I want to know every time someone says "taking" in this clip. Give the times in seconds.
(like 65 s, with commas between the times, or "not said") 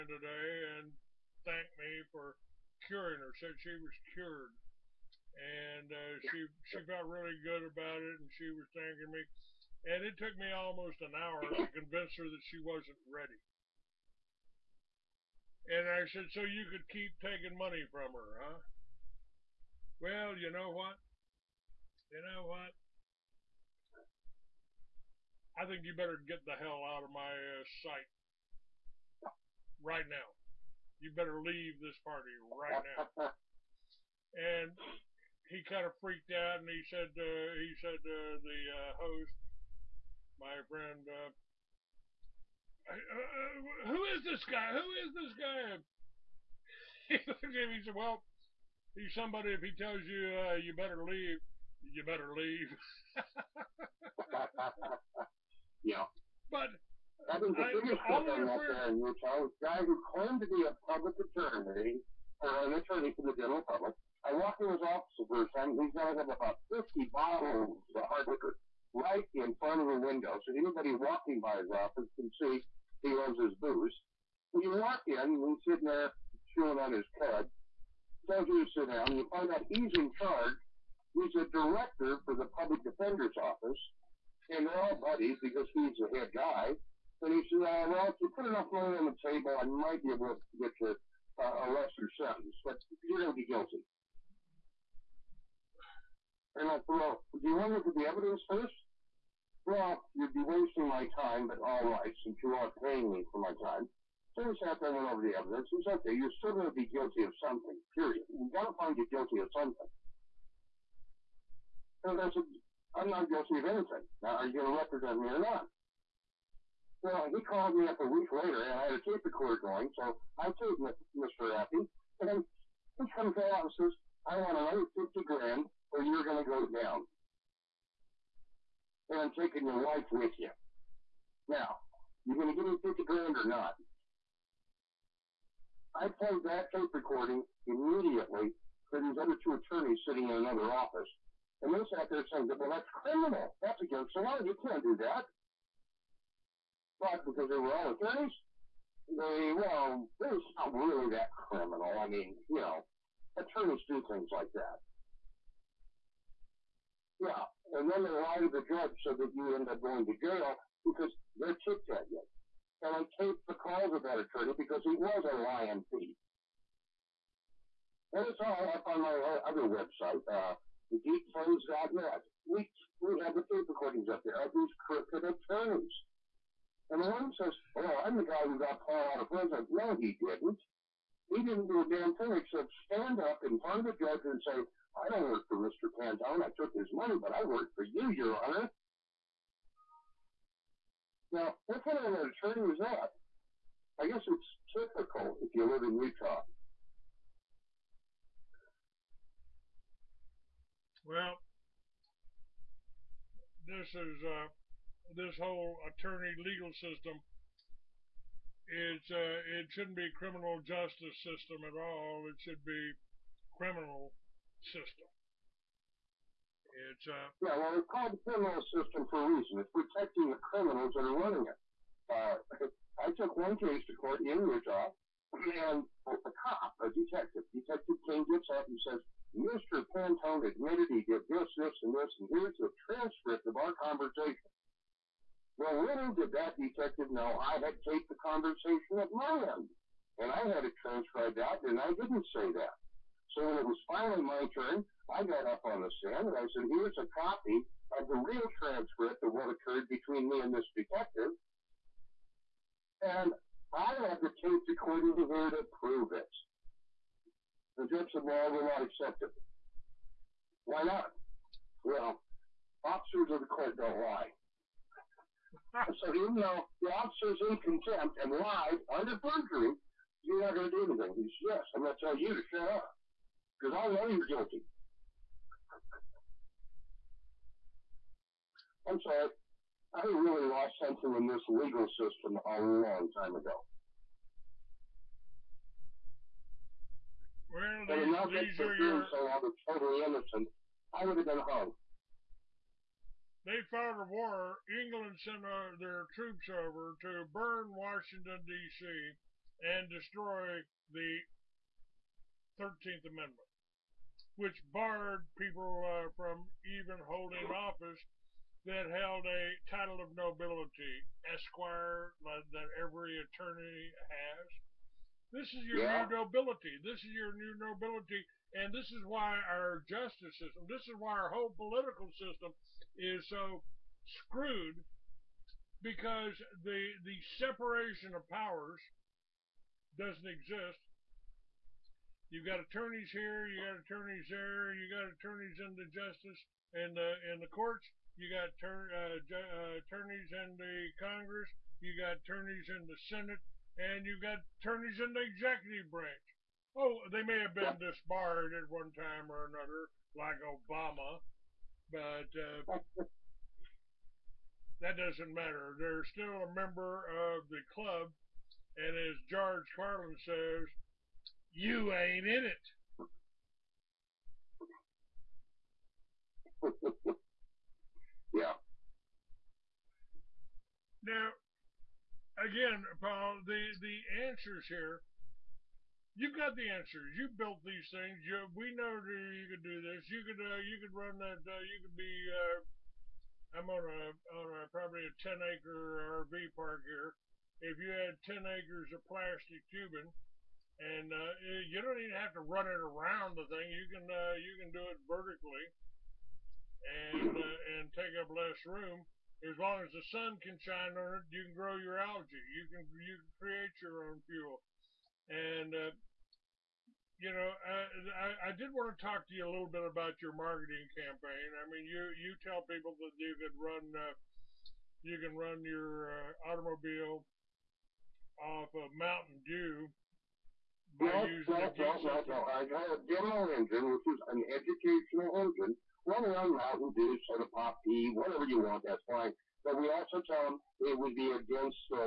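17 s, 129 s.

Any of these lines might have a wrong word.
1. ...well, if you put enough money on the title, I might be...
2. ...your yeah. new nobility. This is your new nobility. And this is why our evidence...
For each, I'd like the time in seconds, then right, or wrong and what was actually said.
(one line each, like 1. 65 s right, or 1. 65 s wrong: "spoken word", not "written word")
1. 87 s wrong: "table", not "title"
2. 315 s wrong: "justice", not "evidence".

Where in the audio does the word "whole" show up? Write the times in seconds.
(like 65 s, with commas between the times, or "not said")
205 s, 321 s.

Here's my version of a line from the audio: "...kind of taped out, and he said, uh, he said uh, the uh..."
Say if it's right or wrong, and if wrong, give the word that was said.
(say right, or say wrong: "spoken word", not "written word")
wrong: "freaked", not "taped".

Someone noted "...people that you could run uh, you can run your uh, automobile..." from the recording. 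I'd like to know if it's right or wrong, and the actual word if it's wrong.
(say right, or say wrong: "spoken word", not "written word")
right.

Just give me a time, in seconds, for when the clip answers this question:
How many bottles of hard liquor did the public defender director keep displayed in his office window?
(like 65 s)
66 s.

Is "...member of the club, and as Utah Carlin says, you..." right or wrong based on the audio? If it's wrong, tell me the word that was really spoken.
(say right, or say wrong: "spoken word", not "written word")
wrong: "George", not "Utah".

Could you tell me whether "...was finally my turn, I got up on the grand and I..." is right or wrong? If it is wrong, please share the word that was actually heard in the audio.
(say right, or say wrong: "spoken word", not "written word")
wrong: "stand", not "grand".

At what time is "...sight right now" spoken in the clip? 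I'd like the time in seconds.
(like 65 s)
27 s.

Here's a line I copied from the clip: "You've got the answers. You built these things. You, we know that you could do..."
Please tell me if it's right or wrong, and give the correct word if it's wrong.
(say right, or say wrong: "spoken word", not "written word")
right.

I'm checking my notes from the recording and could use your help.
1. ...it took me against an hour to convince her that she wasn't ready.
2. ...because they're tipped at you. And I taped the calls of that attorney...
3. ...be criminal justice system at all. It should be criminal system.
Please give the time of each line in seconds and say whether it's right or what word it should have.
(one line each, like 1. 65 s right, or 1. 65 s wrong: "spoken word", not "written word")
1. 10 s wrong: "almost", not "against"
2. 160 s right
3. 209 s right.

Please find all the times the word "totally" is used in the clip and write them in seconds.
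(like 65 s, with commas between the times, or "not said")
289 s.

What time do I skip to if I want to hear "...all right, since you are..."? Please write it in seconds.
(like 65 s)
101 s.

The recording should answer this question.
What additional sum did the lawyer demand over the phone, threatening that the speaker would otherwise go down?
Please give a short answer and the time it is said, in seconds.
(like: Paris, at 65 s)
50 grand, at 124 s.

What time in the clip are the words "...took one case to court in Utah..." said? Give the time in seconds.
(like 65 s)
223 s.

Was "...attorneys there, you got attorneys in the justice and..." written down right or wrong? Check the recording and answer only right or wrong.
right.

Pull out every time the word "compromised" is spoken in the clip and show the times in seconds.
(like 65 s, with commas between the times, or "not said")
not said.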